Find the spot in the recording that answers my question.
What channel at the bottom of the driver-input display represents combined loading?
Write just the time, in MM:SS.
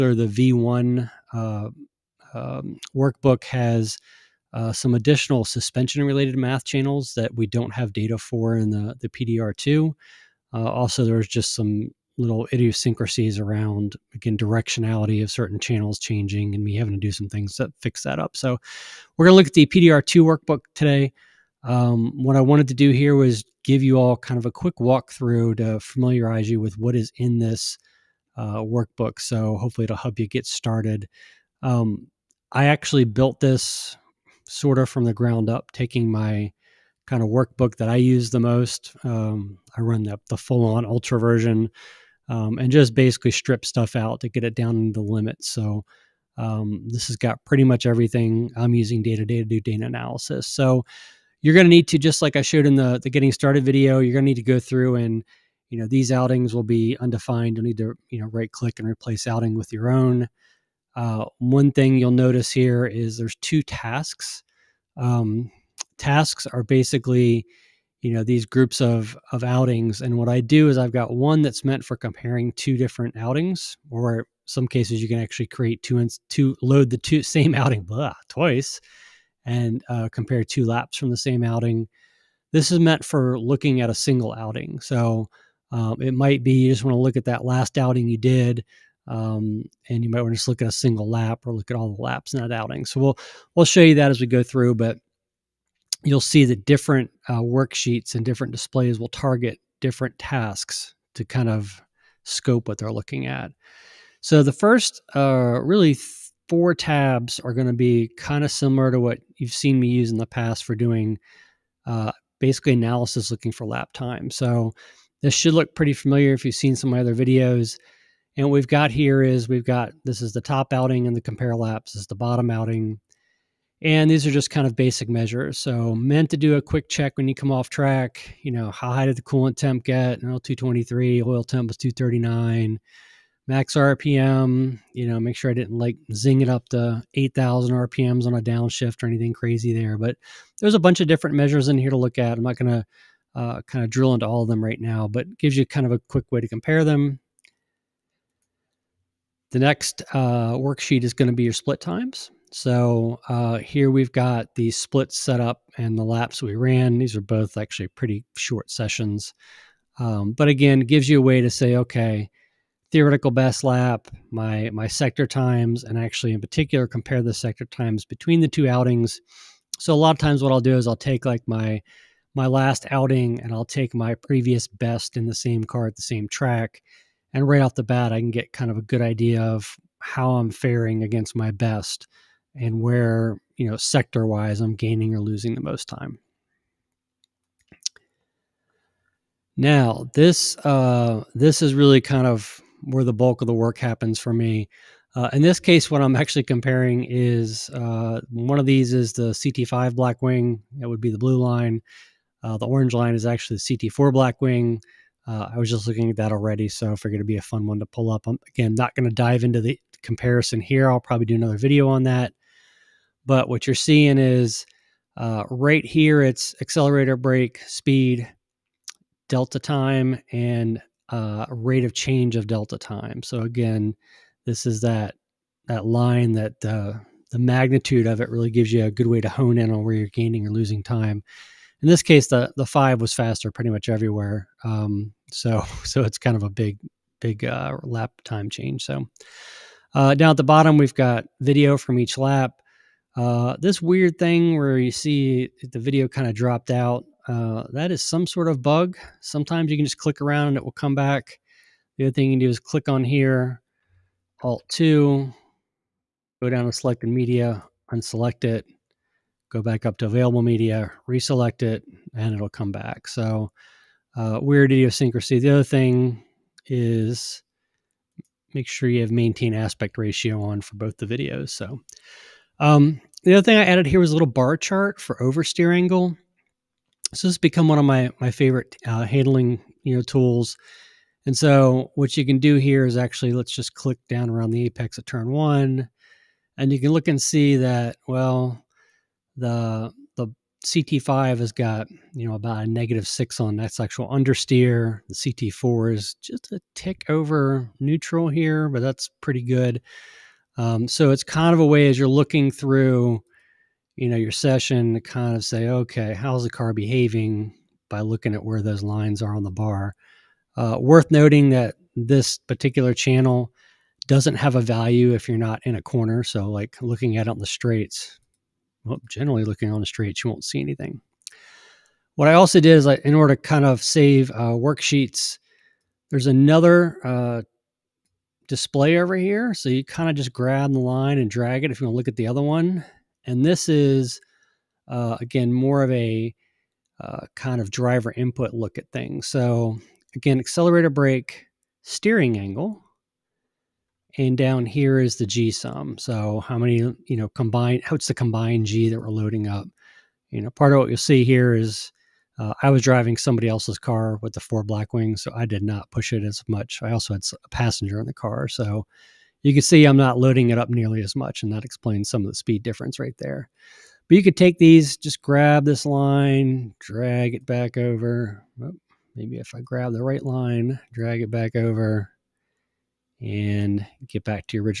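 05:45.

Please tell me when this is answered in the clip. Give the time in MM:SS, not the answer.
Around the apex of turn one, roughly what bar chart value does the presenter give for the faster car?
04:52.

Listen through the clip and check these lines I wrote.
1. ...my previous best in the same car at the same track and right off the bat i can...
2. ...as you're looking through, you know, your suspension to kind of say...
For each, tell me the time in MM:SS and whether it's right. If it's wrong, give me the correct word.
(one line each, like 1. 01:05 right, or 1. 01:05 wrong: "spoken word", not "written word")
1. 02:53 right
2. 05:01 wrong: "session", not "suspension".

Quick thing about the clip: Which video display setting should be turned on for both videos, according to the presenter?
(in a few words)
maintain aspect ratio.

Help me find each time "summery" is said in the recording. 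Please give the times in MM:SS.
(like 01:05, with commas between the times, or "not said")
not said.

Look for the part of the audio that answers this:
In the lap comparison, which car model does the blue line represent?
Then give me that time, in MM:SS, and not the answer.
03:19.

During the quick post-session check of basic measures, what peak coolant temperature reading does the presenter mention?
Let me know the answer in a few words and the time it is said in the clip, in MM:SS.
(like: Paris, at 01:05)
223, at 02:10.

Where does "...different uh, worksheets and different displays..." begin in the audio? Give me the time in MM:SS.
01:36.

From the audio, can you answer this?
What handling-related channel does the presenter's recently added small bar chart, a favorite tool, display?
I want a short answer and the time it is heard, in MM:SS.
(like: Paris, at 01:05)
oversteer angle, at 04:35.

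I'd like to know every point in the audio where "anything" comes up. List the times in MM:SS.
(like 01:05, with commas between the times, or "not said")
02:19, 05:20.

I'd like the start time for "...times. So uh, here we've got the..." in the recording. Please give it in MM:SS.
02:31.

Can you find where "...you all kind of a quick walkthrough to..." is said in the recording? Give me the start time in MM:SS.
00:23.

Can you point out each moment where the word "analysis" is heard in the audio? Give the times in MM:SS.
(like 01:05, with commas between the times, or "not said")
00:49, 01:52.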